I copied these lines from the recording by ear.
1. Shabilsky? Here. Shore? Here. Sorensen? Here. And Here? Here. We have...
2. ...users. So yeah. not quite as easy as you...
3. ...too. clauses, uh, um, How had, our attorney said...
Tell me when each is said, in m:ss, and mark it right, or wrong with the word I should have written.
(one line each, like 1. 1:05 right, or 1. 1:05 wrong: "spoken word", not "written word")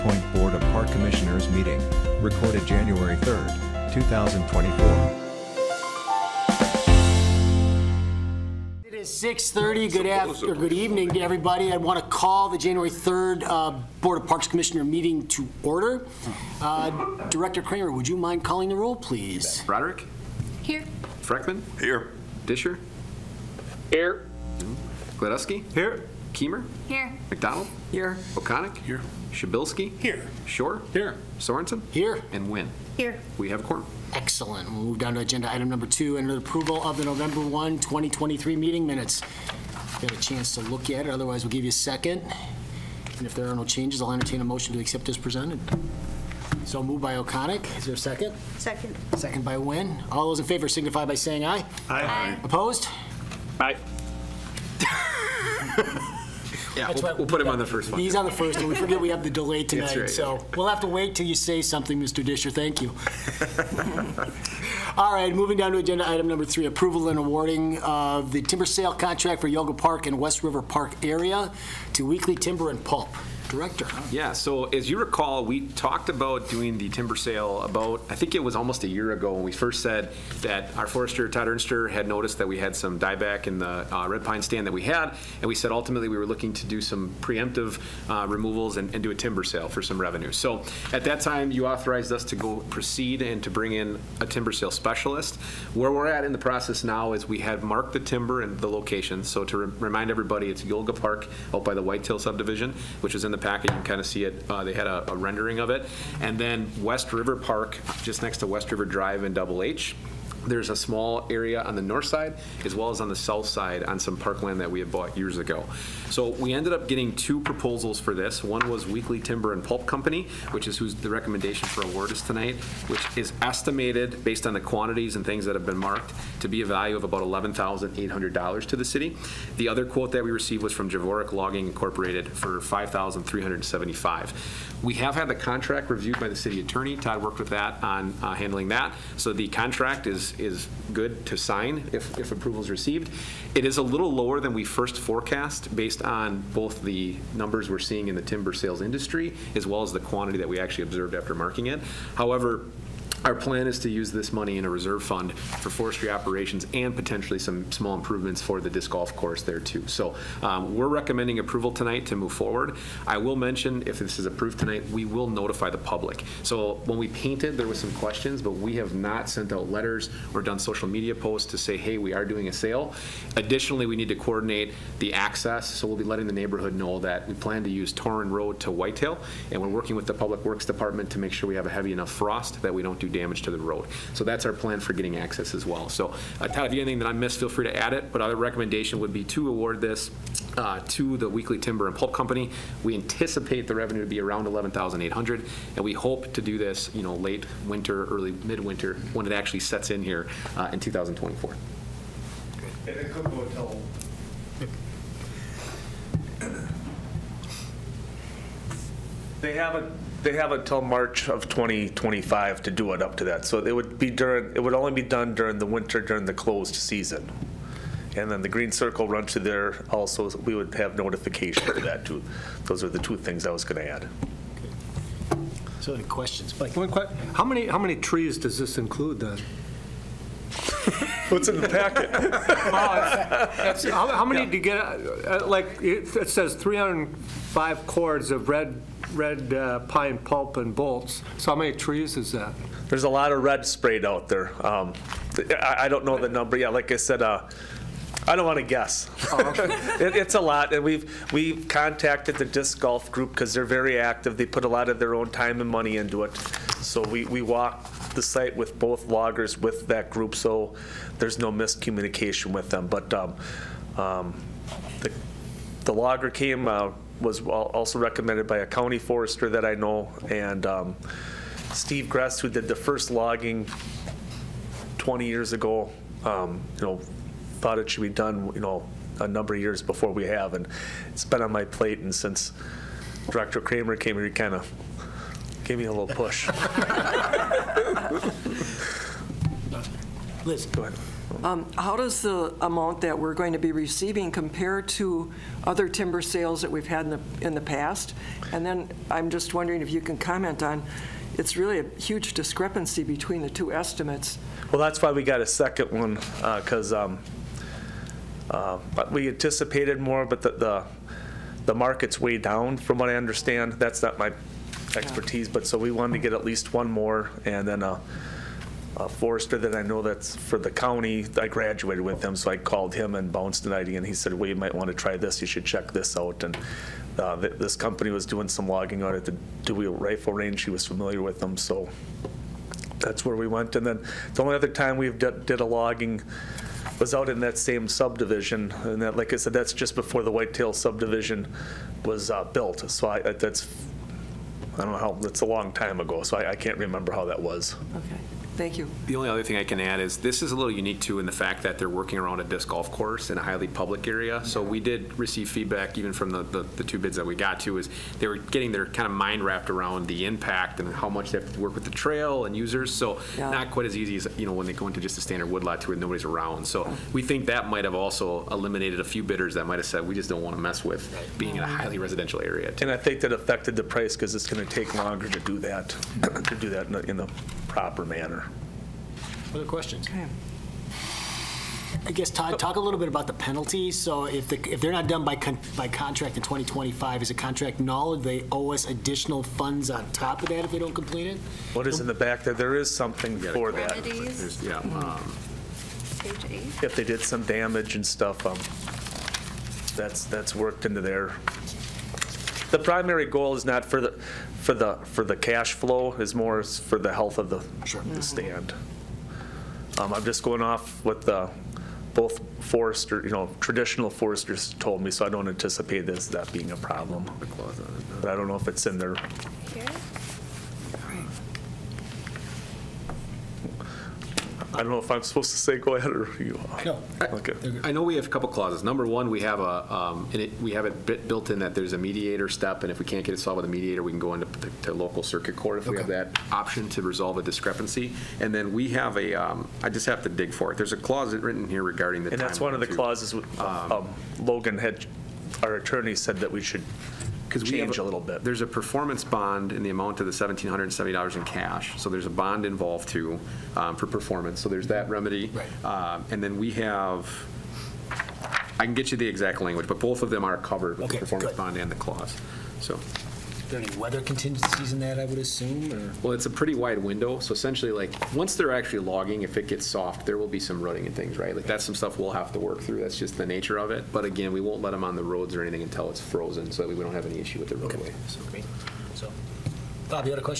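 1. 0:29 wrong: "Wynn", not "Here"
2. 6:02 right
3. 7:22 wrong: "Logan", not "How".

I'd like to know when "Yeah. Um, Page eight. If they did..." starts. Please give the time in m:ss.
6:34.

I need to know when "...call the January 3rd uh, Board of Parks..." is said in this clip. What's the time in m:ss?
0:12.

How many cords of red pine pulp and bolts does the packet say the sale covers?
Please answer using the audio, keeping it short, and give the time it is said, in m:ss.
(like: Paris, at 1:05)
305, at 3:56.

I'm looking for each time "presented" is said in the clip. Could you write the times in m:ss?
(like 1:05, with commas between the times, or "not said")
0:45.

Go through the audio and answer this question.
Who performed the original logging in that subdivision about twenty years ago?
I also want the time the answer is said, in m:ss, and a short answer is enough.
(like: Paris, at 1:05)
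Steve Gress, at 4:31.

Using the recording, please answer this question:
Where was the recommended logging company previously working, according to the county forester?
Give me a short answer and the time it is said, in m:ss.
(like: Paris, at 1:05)
Dewey Rifle Range, at 5:29.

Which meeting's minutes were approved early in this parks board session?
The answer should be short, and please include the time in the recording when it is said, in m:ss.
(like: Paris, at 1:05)
November 1, 2023, at 0:37.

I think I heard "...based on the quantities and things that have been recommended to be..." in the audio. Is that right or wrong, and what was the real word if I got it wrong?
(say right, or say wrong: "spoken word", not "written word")
wrong: "marked", not "recommended".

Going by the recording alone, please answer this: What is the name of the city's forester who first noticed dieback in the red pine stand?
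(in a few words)
Todd Ernster.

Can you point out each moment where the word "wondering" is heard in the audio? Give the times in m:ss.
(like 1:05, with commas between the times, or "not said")
4:59.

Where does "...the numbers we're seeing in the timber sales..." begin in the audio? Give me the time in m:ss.
2:26.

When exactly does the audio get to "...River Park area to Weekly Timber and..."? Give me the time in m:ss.
1:10.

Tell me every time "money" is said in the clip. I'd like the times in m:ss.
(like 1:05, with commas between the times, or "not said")
2:34, 4:15.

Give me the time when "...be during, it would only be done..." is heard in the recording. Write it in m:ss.
3:33.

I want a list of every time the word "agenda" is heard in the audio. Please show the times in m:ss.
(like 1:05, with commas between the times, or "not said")
0:35, 1:05.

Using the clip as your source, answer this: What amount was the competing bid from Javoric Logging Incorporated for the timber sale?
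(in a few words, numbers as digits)
$5,375.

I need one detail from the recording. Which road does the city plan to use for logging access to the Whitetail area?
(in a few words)
Torun Road.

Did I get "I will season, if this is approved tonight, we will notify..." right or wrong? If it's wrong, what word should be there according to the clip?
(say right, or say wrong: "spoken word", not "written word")
wrong: "mention", not "season".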